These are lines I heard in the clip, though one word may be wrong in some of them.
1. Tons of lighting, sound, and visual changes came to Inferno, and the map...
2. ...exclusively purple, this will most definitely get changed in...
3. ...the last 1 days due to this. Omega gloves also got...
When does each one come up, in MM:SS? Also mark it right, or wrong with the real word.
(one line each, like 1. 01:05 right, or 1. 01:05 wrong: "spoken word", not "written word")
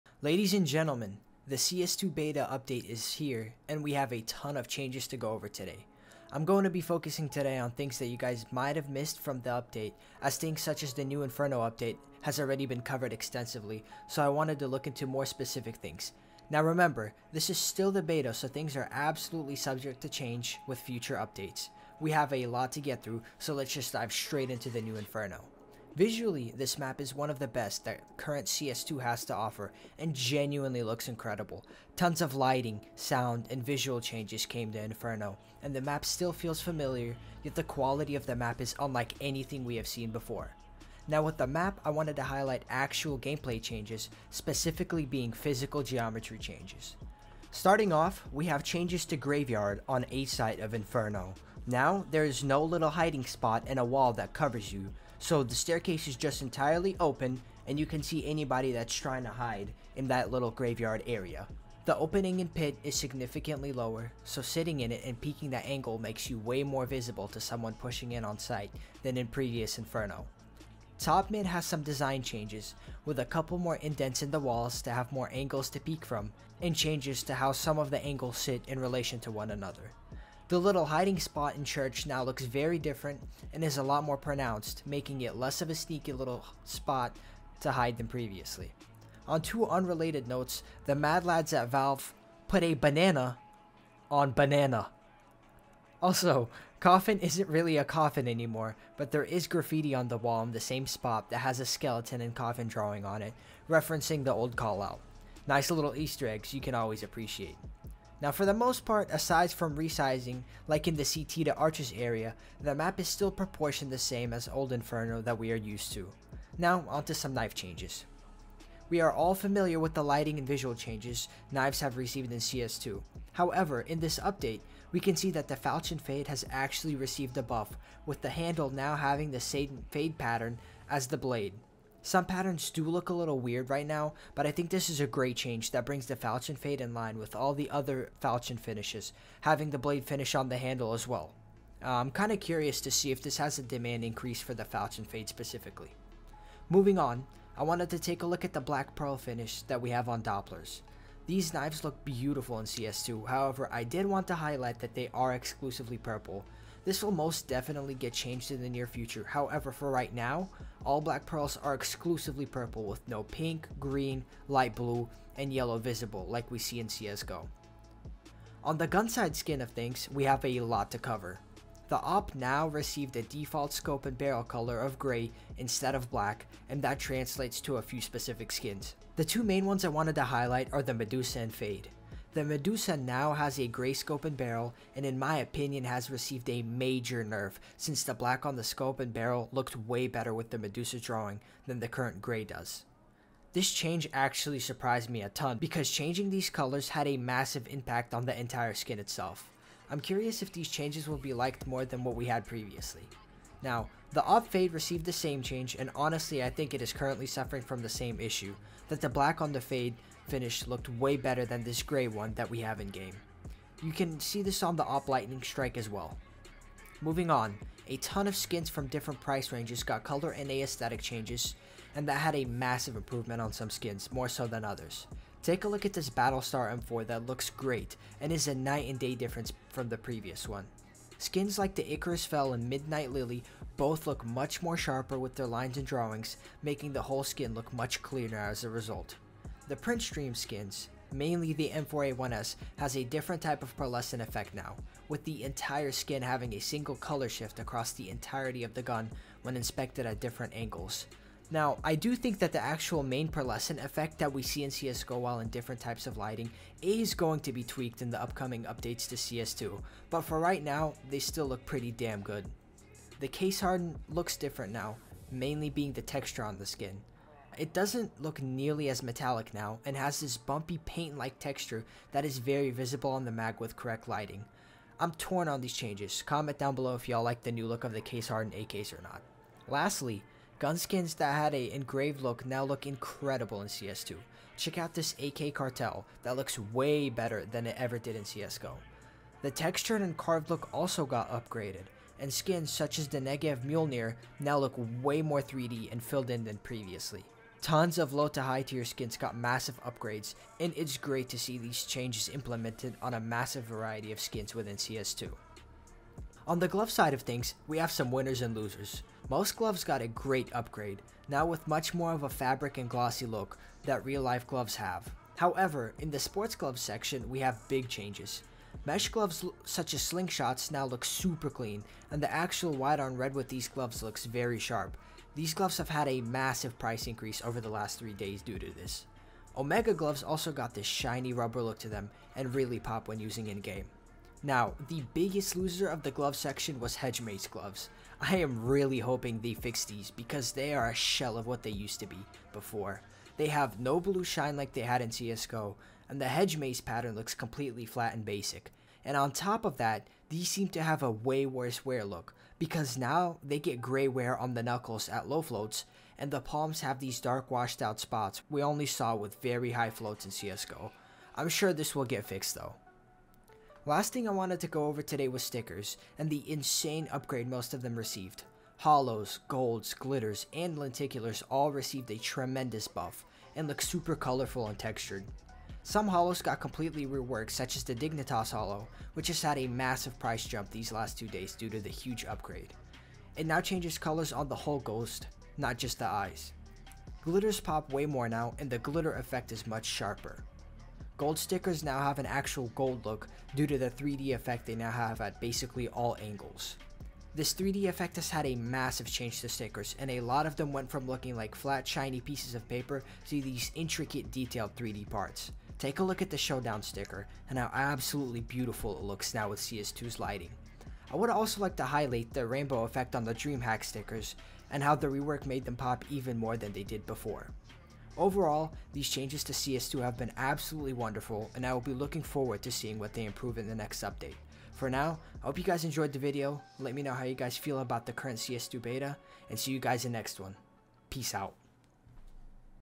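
1. 00:31 right
2. 02:35 right
3. 05:27 wrong: "3", not "1".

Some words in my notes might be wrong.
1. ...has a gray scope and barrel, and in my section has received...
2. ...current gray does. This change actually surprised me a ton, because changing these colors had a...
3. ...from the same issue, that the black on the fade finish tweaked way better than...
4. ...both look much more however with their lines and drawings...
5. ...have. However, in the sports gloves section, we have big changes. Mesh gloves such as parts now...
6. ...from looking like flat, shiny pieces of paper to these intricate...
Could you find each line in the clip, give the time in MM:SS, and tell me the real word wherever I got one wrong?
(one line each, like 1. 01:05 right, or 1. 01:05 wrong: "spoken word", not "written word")
1. 03:03 wrong: "opinion", not "section"
2. 03:11 right
3. 03:27 wrong: "looked", not "tweaked"
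4. 03:53 wrong: "sharper", not "however"
5. 05:14 wrong: "slingshots", not "parts"
6. 06:40 right.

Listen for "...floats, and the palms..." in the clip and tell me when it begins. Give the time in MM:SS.
05:55.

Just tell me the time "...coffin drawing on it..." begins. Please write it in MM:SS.
01:42.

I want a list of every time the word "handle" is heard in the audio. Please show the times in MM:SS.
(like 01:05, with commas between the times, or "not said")
02:08, 02:20.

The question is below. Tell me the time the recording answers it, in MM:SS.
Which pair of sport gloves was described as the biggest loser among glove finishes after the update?
05:36.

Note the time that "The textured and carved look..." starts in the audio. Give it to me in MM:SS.
04:49.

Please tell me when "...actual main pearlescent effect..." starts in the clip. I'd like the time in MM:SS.
04:12.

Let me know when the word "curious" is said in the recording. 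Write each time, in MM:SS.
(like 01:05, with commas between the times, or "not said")
02:22, 03:19.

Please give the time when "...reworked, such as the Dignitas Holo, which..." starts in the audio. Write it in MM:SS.
06:17.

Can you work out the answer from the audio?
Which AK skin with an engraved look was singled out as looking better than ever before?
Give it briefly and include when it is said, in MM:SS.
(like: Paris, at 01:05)
Cartel, at 04:45.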